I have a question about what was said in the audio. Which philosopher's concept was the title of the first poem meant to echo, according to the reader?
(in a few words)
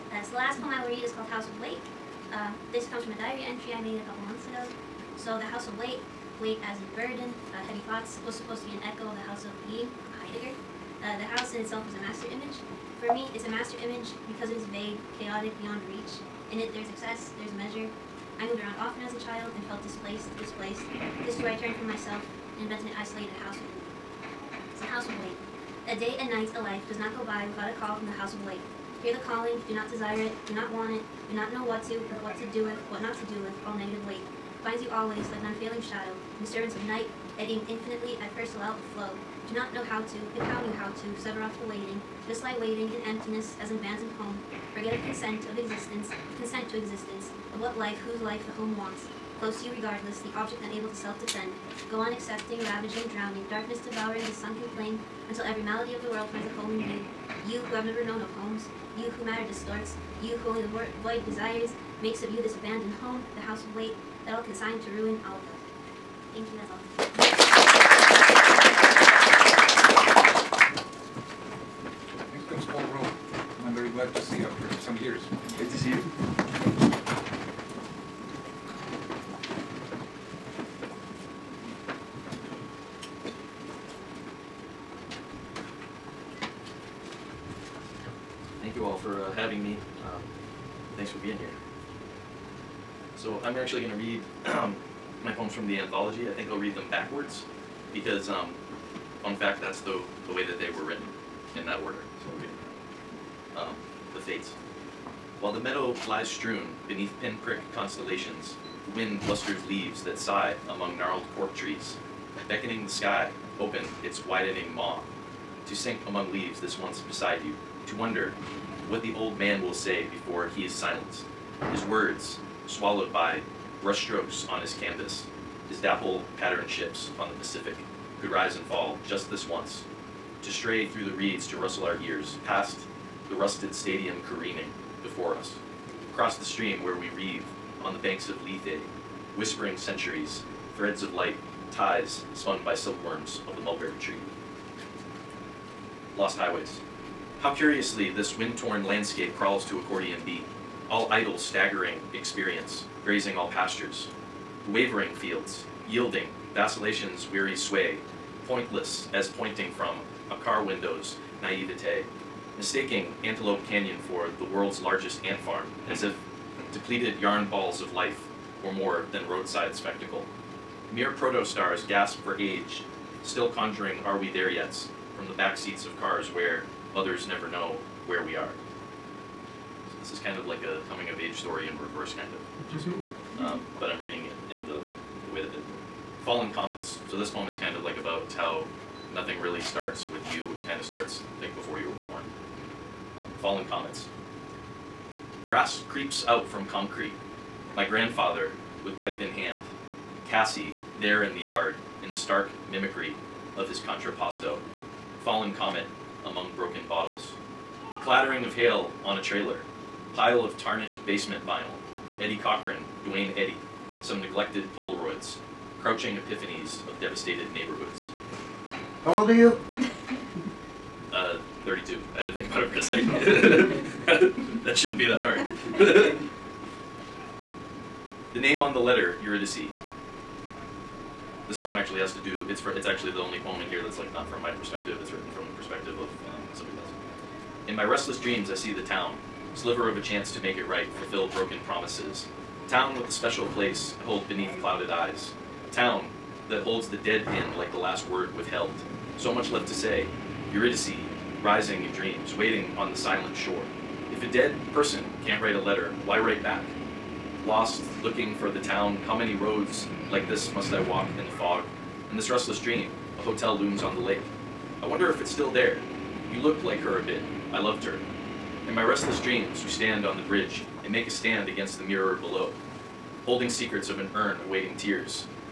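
Heidegger.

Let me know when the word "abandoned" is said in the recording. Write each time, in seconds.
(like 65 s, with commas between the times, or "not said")
43 s, 62 s.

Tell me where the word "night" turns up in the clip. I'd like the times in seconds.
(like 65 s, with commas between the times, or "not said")
26 s, 36 s.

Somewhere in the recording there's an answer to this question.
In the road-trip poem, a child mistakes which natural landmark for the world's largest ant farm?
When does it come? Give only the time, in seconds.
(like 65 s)
163 s.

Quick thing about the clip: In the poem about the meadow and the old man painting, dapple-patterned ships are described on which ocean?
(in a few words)
Pacific.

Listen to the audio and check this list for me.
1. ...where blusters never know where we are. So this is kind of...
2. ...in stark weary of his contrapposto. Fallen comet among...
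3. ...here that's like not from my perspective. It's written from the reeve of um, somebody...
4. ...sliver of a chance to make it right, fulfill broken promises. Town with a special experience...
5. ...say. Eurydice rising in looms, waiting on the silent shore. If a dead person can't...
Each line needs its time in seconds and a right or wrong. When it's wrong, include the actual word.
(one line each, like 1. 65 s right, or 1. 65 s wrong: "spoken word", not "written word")
1. 176 s wrong: "mothers", not "blusters"
2. 202 s wrong: "mimicry", not "weary"
3. 233 s wrong: "perspective", not "reeve"
4. 239 s wrong: "place", not "experience"
5. 249 s wrong: "dreams", not "looms".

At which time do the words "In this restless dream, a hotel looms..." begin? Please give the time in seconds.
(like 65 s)
262 s.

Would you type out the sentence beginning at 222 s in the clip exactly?
I had to think about it for a second.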